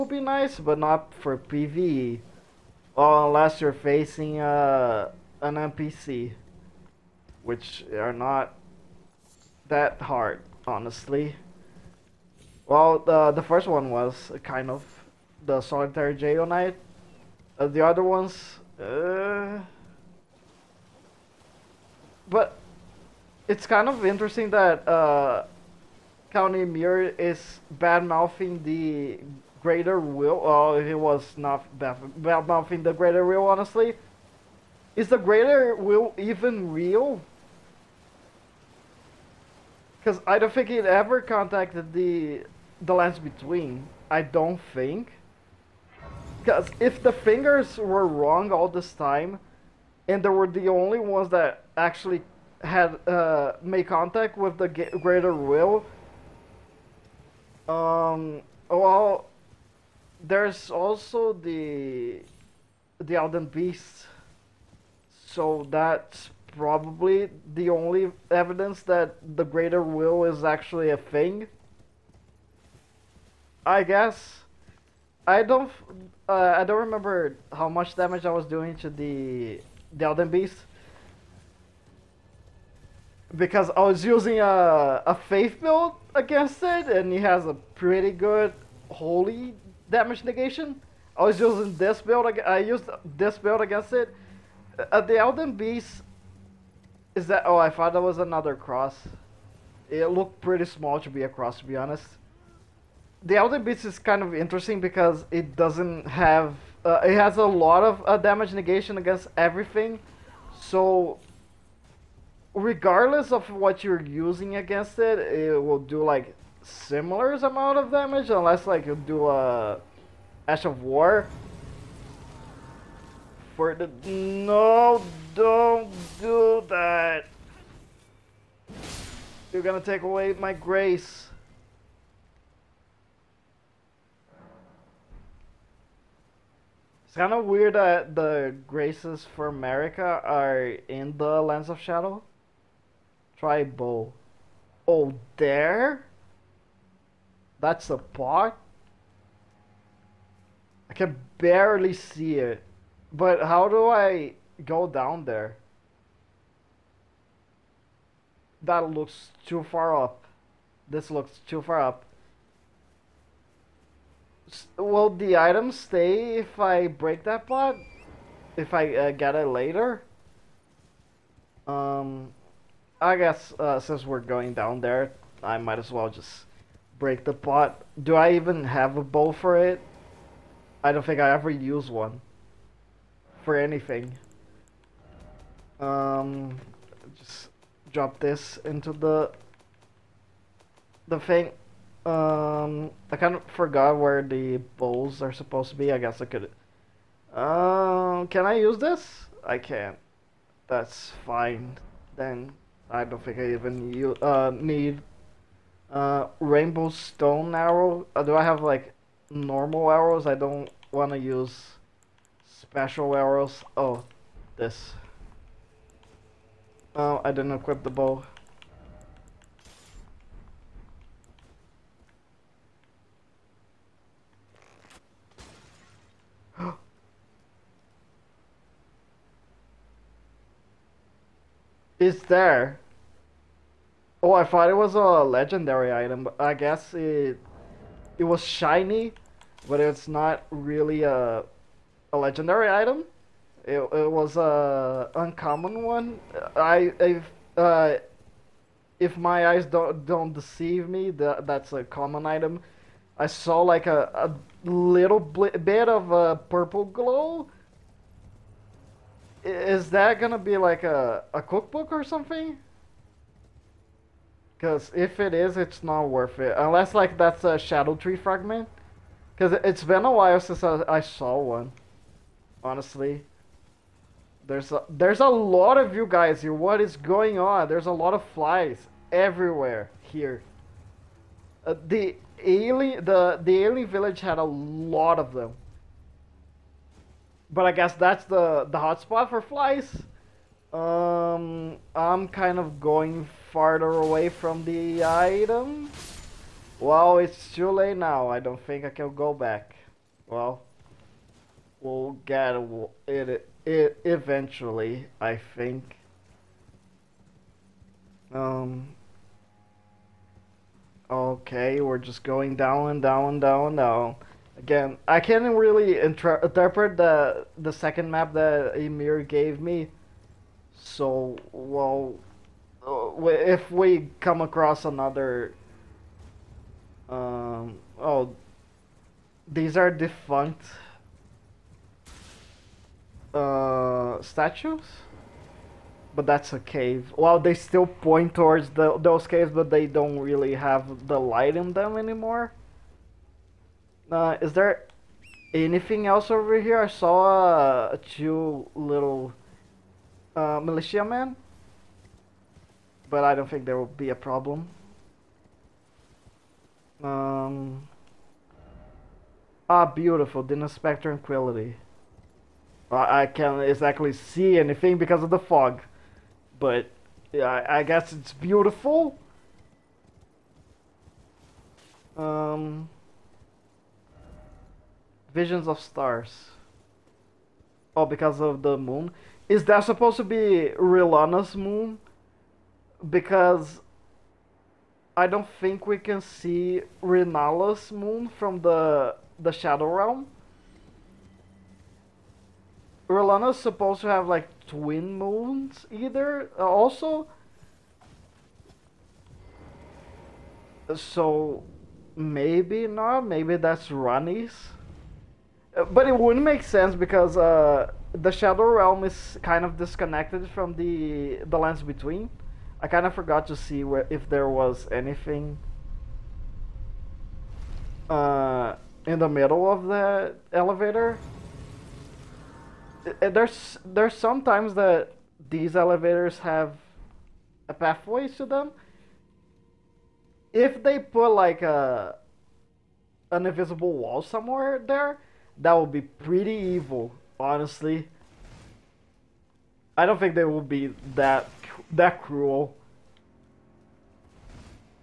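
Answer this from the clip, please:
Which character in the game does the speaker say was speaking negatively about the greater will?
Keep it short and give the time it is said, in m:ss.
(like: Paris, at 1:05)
Count Ymir, at 0:26.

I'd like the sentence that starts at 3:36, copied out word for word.
Oh, I didn't equip the bow.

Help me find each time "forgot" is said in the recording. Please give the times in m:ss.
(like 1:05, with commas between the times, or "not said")
3:13, 6:53.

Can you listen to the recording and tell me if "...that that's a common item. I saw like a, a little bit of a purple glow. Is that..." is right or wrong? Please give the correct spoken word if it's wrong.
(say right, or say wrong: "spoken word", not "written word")
right.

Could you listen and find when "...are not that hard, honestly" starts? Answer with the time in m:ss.
0:07.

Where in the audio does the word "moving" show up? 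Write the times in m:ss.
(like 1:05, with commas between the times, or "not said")
not said.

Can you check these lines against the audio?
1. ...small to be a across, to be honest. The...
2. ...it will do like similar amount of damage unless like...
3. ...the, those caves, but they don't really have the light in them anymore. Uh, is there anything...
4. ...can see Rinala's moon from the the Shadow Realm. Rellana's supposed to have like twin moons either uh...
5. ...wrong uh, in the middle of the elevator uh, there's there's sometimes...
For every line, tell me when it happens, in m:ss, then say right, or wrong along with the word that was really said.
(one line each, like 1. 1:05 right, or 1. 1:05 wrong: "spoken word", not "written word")
1. 1:40 wrong: "cross", not "across"
2. 1:55 right
3. 5:38 right
4. 6:25 right
5. 6:54 wrong: "anything", not "wrong".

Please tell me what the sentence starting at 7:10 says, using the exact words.
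If they put like a an invisible wall somewhere there, that would be pretty evil, honestly.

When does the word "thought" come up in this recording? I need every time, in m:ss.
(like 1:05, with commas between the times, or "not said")
1:37, 3:54.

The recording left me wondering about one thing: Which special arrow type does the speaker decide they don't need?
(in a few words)
rainbow stone arrow.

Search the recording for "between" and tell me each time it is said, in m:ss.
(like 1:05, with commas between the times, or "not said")
0:43, 6:51.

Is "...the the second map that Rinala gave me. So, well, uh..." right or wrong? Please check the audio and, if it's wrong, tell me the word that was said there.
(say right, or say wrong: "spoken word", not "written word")
wrong: "Ymir", not "Rinala".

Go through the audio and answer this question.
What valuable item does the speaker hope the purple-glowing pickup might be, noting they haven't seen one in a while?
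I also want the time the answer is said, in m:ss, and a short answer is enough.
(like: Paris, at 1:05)
Scadutree fragment, at 4:27.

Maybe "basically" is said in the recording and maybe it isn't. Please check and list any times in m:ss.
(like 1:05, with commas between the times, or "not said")
not said.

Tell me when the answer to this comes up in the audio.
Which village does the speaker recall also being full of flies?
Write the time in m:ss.
4:43.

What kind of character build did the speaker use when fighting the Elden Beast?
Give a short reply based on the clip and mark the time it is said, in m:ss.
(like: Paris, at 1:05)
faith build, at 1:25.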